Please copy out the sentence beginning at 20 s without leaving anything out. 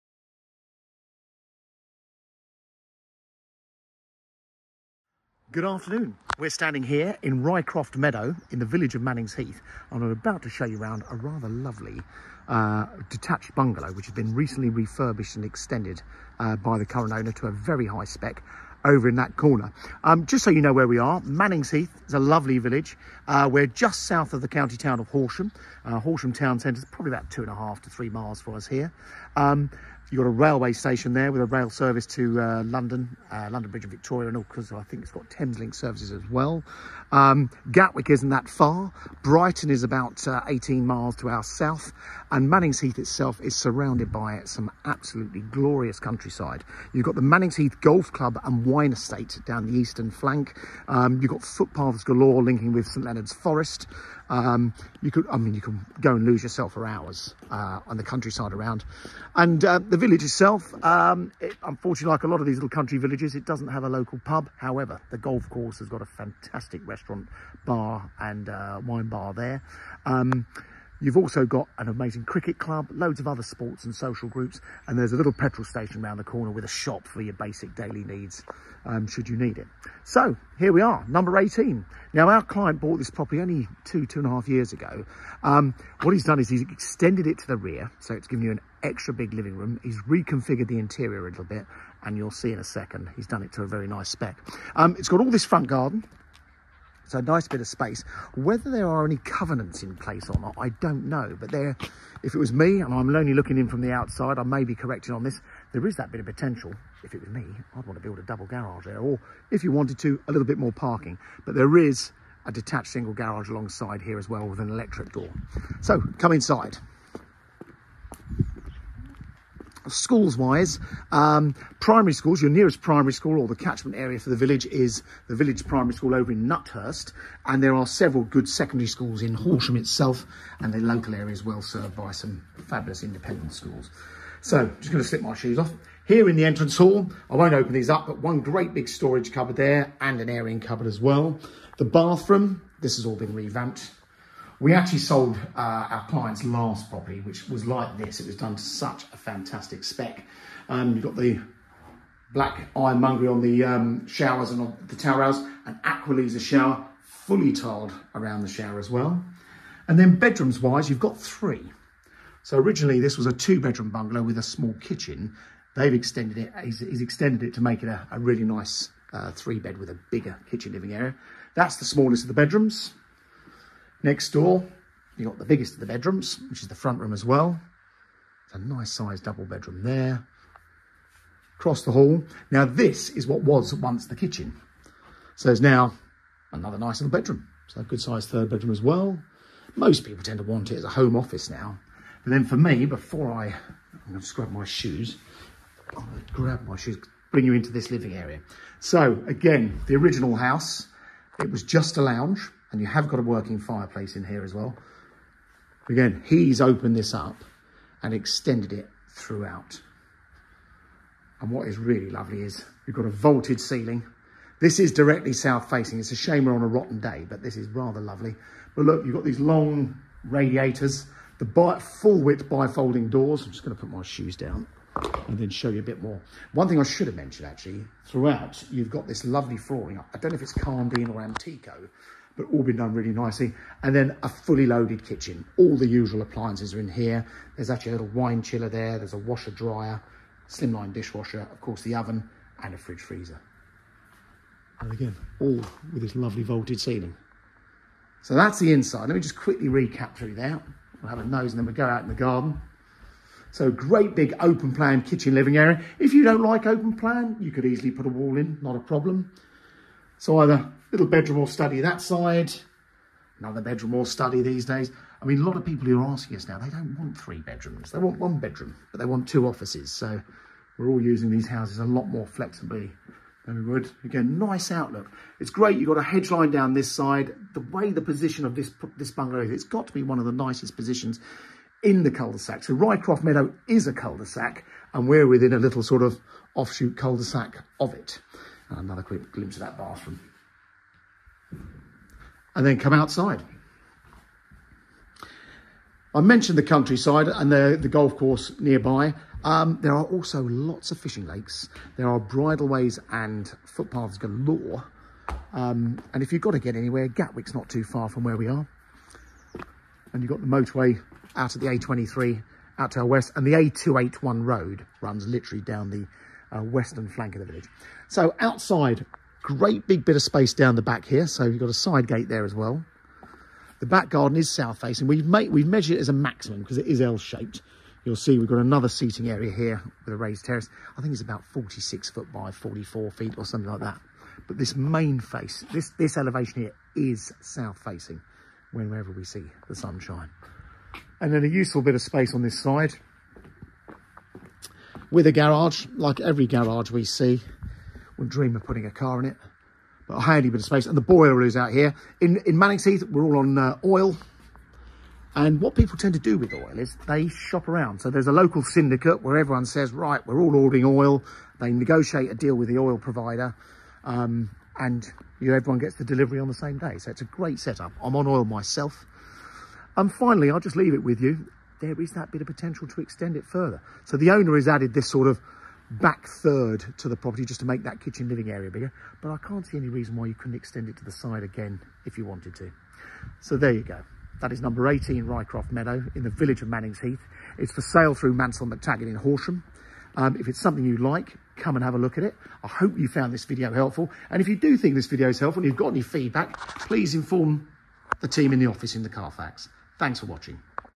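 Um, just so you know where we are, Mannings Heath is a lovely village.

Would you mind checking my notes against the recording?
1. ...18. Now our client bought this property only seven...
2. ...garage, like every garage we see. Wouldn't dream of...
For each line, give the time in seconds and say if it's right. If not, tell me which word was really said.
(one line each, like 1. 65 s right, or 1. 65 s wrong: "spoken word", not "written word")
1. 81 s wrong: "two", not "seven"
2. 345 s right.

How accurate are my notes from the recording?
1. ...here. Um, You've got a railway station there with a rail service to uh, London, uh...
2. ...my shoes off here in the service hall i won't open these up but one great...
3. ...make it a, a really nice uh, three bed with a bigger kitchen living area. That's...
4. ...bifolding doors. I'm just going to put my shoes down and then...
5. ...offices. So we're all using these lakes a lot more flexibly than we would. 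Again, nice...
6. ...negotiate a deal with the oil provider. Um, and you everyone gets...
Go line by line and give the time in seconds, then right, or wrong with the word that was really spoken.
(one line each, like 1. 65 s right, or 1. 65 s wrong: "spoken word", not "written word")
1. 28 s right
2. 135 s wrong: "entrance", not "service"
3. 167 s right
4. 222 s right
5. 269 s wrong: "houses", not "lakes"
6. 361 s right.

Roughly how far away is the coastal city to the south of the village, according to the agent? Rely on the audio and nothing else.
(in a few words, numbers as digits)
18 miles.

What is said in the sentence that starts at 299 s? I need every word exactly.
Um, there are also lots of fishing lakes.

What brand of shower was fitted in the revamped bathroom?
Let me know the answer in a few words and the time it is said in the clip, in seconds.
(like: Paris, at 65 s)
Aqualisa, at 155 s.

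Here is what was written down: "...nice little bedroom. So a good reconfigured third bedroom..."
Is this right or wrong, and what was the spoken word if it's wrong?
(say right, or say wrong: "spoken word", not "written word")
wrong: "sized", not "reconfigured".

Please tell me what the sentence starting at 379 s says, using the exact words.
But I can't see any reason why you couldn't extend it to the side again if you wanted to.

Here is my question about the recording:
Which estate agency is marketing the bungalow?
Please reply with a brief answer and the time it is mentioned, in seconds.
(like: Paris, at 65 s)
Mansell McTaggart, at 388 s.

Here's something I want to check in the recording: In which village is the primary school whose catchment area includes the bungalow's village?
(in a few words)
Nuthurst.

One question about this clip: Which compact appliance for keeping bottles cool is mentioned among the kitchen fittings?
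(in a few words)
Wine chiller.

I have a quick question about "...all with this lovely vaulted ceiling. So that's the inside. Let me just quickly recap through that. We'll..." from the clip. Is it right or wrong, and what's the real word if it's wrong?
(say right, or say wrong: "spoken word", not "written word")
right.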